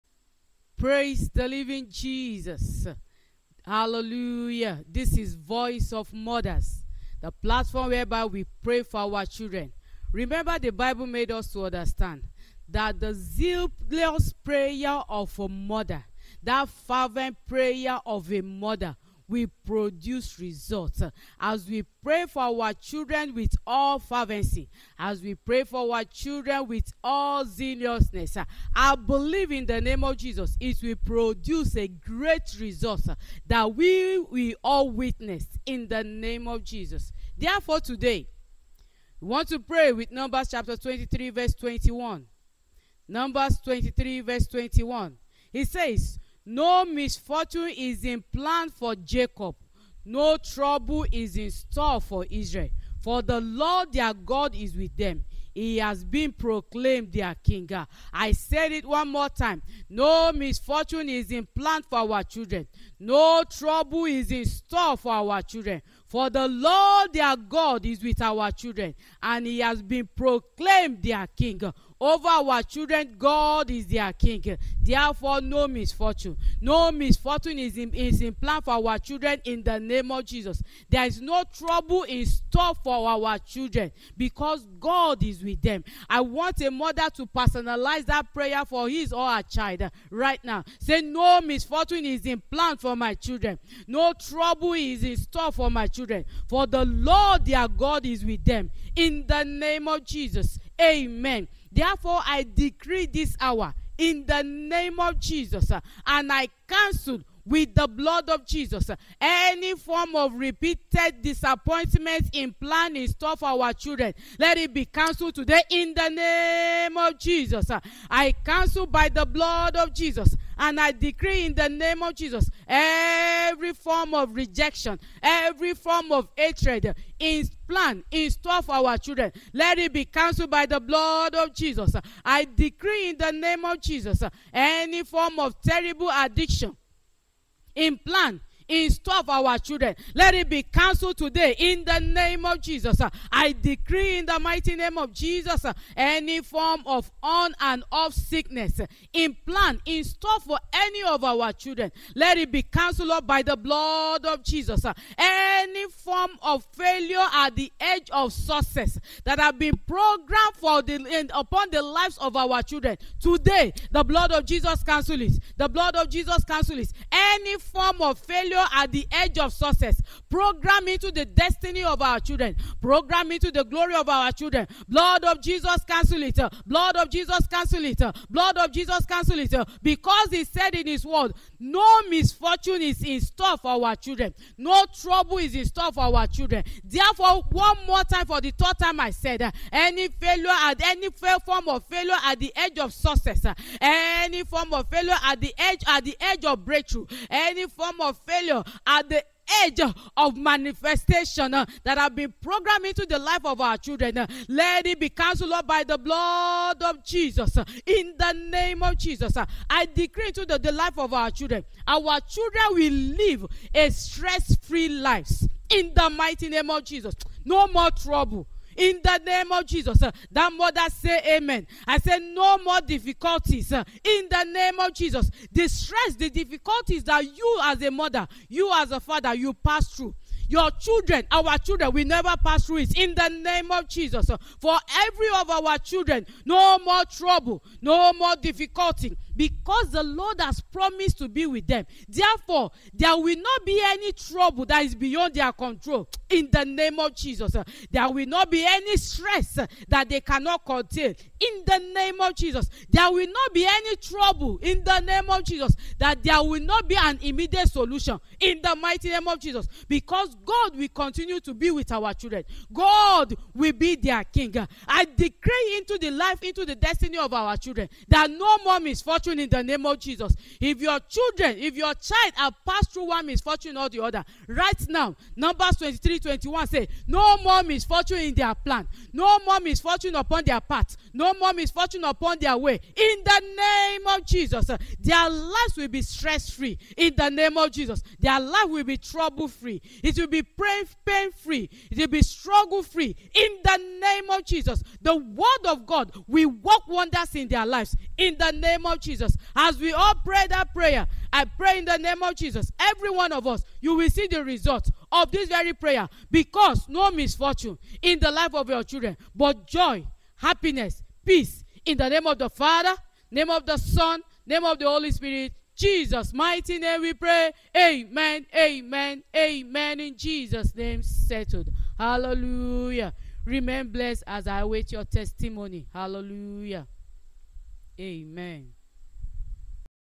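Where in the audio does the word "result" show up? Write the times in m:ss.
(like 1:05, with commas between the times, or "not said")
0:20, 0:32, 5:04.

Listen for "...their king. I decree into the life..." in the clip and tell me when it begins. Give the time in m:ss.
4:23.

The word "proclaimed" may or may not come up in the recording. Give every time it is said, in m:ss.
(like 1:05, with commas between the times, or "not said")
0:56, 1:10.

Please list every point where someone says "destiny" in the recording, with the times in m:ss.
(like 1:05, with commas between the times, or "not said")
2:51, 4:26.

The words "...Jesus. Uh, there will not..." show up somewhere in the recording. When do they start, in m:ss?
4:07.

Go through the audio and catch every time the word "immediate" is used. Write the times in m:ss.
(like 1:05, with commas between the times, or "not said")
4:17.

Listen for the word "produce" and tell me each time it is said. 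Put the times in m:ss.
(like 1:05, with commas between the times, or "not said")
0:19, 0:31.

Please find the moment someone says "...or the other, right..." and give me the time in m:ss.
4:33.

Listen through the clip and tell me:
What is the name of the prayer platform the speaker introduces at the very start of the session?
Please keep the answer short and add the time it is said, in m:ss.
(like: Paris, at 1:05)
Voice of Mothers, at 0:05.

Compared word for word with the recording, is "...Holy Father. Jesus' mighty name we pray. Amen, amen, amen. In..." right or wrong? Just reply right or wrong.
wrong.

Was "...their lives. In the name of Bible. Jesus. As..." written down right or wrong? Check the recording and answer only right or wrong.
wrong.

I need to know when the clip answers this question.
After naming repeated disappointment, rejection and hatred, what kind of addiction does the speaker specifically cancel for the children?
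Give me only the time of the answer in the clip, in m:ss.
2:15.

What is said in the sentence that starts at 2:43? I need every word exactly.
Today, the blood of Jesus cancels it.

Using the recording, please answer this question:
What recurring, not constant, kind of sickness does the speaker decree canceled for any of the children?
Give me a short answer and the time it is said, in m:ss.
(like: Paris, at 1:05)
On and off sickness, at 2:27.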